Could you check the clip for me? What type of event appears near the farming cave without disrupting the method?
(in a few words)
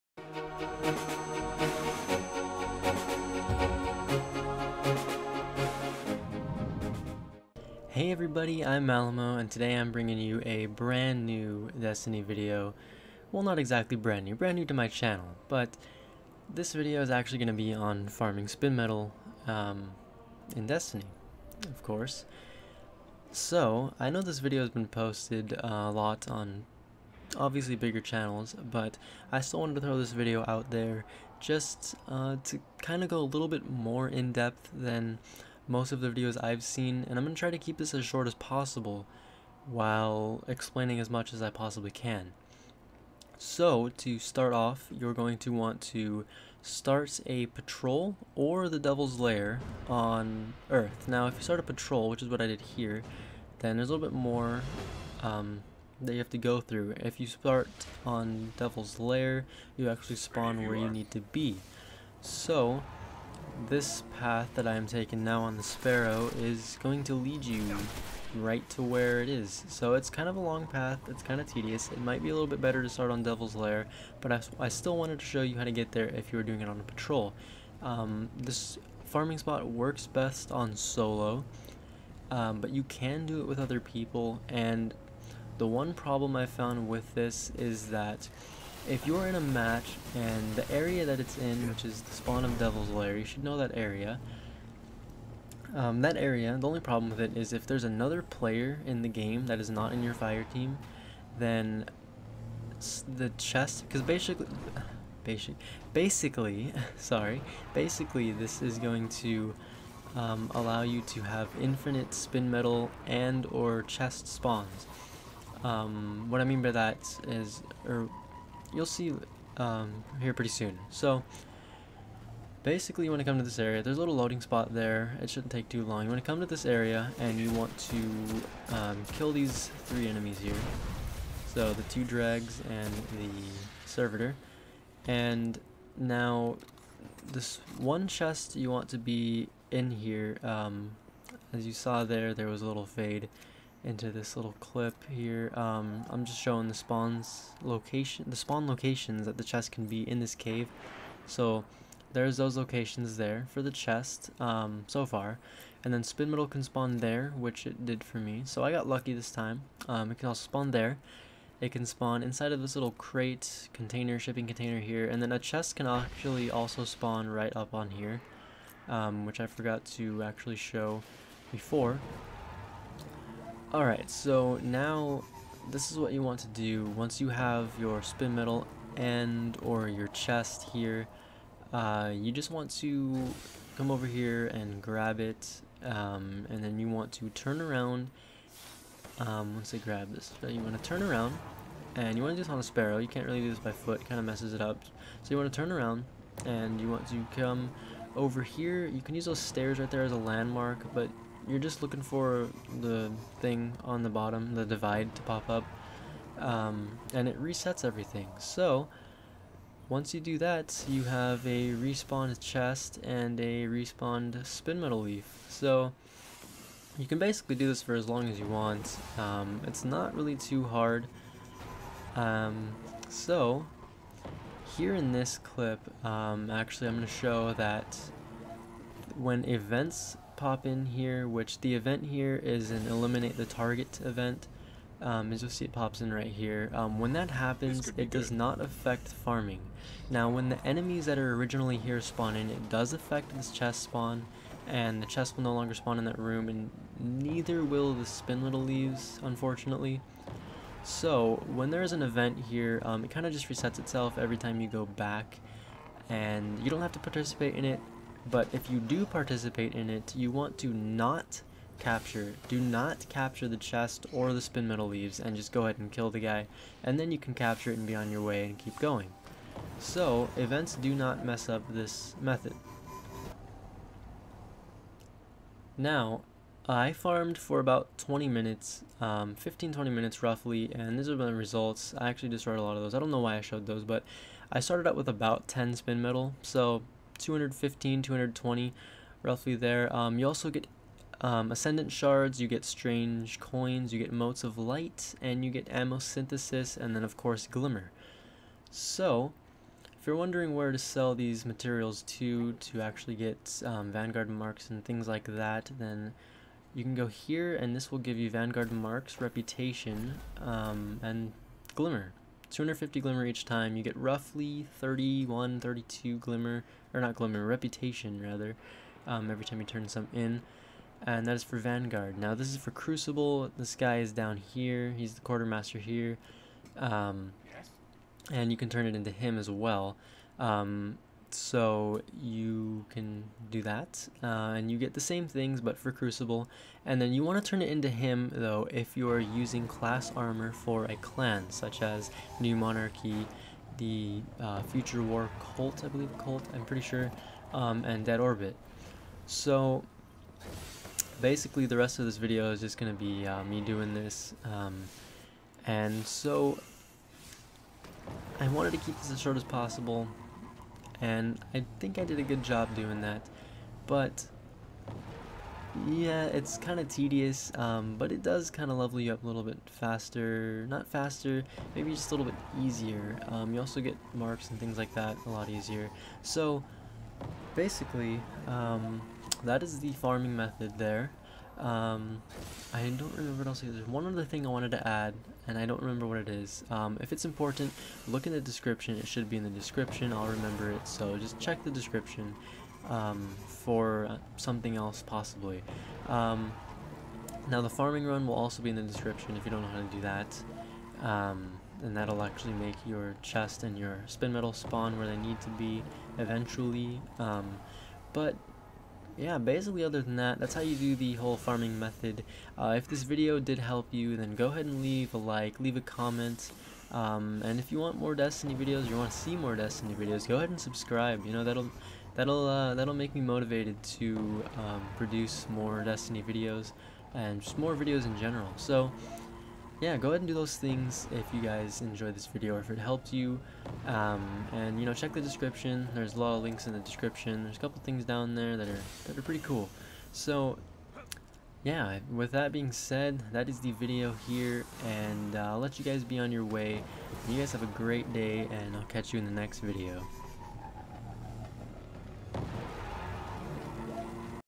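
eliminate the target.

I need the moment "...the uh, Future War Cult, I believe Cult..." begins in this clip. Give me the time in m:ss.
5:43.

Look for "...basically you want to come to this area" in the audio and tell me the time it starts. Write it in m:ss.
2:02.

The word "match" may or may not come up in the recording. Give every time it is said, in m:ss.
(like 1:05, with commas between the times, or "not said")
1:29.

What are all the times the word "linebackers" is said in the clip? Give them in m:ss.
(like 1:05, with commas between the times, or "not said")
not said.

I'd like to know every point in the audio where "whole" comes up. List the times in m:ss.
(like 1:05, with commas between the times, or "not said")
6:51.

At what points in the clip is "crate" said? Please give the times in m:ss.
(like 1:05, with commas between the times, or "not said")
2:42.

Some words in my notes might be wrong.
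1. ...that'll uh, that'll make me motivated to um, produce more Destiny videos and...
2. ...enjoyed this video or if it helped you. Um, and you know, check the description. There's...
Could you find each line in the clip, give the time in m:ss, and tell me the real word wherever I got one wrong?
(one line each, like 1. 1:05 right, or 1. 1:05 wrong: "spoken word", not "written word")
1. 7:02 right
2. 7:11 right.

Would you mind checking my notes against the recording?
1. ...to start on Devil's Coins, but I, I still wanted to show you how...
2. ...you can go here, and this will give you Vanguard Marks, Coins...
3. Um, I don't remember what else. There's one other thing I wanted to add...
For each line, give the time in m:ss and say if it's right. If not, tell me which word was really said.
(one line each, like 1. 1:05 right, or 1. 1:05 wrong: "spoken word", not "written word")
1. 1:12 wrong: "Lair", not "Coins"
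2. 5:06 wrong: "Reputation", not "Coins"
3. 6:21 right.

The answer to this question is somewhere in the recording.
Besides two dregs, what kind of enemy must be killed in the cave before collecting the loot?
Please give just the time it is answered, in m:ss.
2:13.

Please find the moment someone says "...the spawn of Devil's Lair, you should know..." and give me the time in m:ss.
1:32.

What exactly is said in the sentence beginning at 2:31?
So there's those locations there for the chest um, so far.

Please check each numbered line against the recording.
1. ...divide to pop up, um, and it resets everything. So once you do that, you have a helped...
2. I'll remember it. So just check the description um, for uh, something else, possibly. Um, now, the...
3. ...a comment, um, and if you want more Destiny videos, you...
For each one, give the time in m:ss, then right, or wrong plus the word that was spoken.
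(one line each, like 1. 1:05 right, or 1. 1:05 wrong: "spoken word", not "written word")
1. 3:24 wrong: "respawned", not "helped"
2. 6:30 right
3. 6:55 right.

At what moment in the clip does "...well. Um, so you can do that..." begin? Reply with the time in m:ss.
5:29.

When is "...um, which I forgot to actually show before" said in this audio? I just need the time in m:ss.
2:48.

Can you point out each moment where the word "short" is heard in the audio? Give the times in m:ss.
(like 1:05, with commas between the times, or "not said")
0:38, 5:59.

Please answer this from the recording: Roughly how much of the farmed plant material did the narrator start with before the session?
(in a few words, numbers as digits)
10.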